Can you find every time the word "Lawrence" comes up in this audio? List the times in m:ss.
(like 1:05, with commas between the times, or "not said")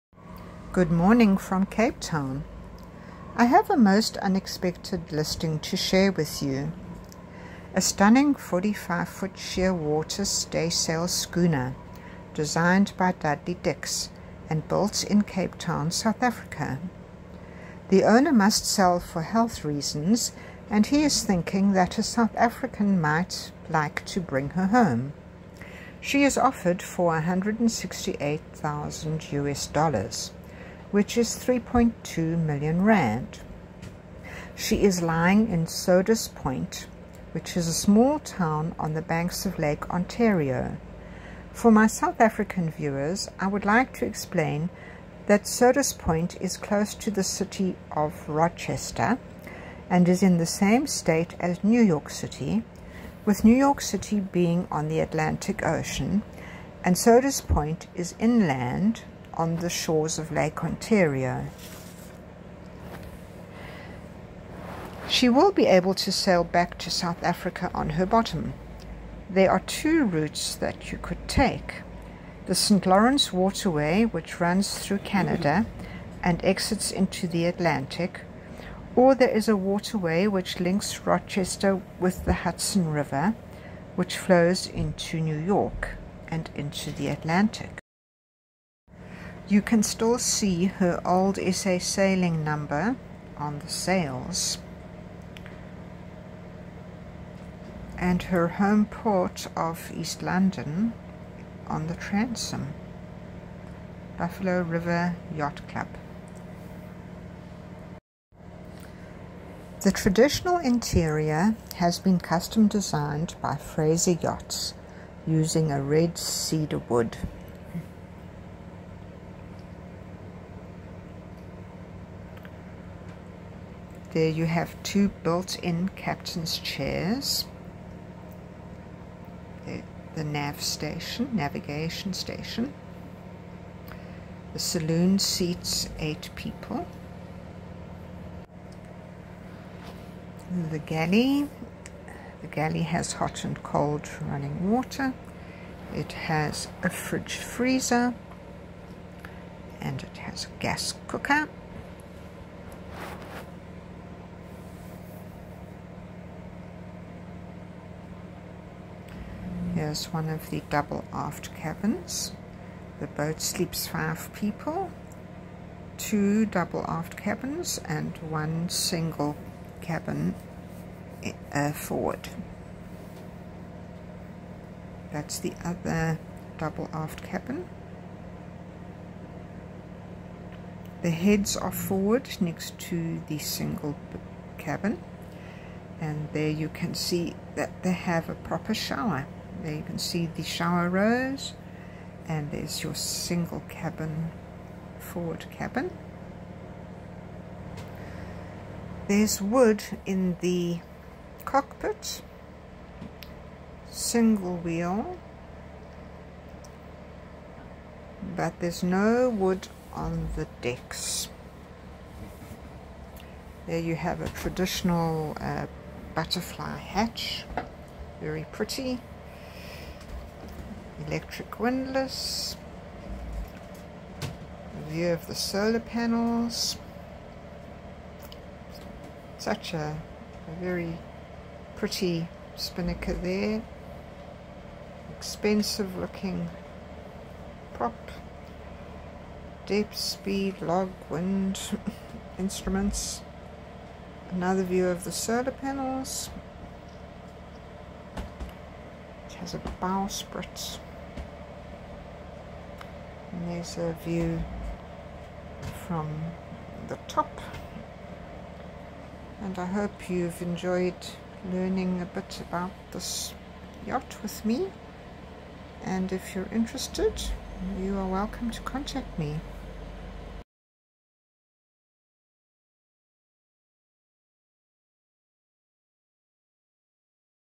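1:12.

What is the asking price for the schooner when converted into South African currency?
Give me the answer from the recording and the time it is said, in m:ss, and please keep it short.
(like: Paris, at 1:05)
3.2 million rand, at 0:31.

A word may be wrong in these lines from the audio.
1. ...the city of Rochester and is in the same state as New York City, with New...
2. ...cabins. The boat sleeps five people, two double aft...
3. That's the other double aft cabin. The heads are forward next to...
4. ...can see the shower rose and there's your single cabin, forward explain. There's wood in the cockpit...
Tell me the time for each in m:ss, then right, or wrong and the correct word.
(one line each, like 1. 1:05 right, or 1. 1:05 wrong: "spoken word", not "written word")
1. 0:47 right
2. 2:41 right
3. 2:55 right
4. 3:09 wrong: "cabin", not "explain".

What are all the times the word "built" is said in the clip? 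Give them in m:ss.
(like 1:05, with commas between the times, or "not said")
0:14, 2:05.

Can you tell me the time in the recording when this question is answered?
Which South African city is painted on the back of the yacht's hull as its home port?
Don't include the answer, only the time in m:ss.
1:39.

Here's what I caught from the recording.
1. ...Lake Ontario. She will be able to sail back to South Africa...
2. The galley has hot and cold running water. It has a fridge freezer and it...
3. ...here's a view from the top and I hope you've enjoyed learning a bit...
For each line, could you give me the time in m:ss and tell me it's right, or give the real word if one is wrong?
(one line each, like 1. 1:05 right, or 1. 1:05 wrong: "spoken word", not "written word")
1. 1:00 right
2. 2:22 right
3. 4:13 right.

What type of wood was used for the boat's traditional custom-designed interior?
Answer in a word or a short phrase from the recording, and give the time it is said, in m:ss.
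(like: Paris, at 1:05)
red cedar, at 1:55.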